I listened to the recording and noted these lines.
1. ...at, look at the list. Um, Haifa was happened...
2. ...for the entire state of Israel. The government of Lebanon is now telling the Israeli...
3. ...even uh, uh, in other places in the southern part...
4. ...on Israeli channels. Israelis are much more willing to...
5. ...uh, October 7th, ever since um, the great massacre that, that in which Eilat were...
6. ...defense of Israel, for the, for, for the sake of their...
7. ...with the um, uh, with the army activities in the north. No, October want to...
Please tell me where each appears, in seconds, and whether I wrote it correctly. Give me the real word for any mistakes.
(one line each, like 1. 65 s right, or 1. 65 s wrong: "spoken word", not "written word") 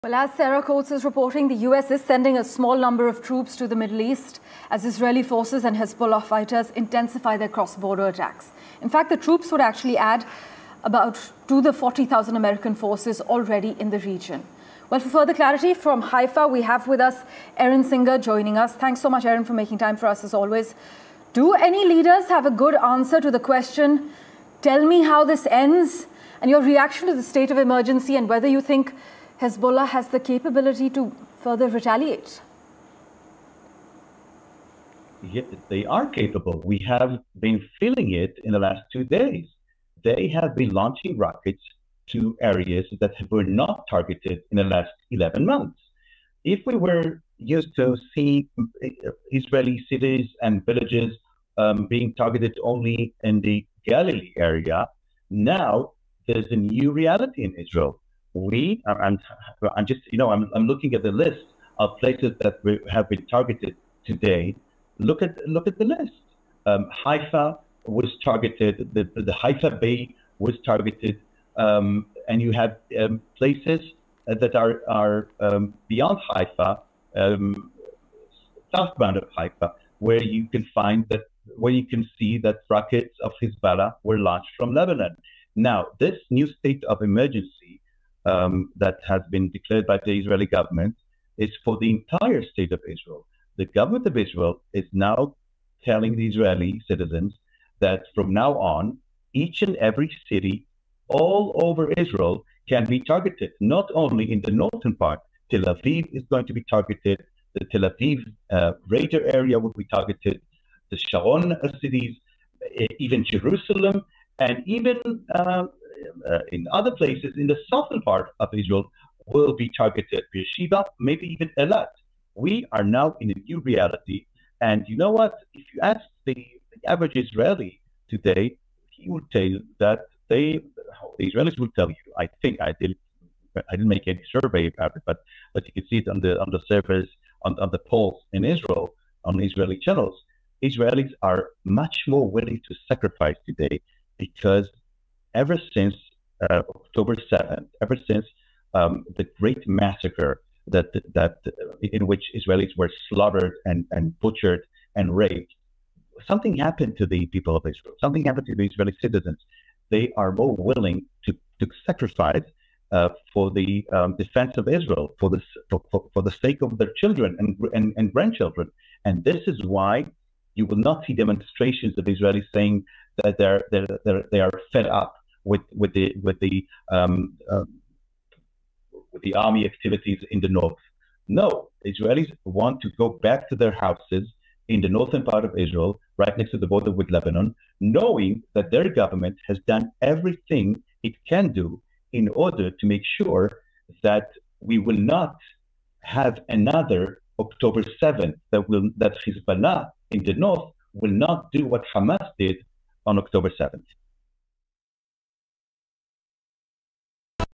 1. 65 s wrong: "targeted", not "happened"
2. 91 s wrong: "Israel", not "Lebanon"
3. 114 s right
4. 139 s right
5. 146 s wrong: "Israelis", not "Eilat"
6. 164 s right
7. 176 s wrong: "Israelis", not "October".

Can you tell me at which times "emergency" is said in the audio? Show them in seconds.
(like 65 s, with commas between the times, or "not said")
27 s, 87 s.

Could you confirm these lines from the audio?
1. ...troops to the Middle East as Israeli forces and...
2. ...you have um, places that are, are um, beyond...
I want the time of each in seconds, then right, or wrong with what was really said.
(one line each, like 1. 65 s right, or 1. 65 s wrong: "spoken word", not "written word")
1. 3 s right
2. 72 s right.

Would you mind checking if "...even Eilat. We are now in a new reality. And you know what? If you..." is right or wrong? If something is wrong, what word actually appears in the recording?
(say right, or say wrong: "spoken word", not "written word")
right.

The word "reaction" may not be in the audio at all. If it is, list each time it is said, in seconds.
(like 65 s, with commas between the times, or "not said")
26 s.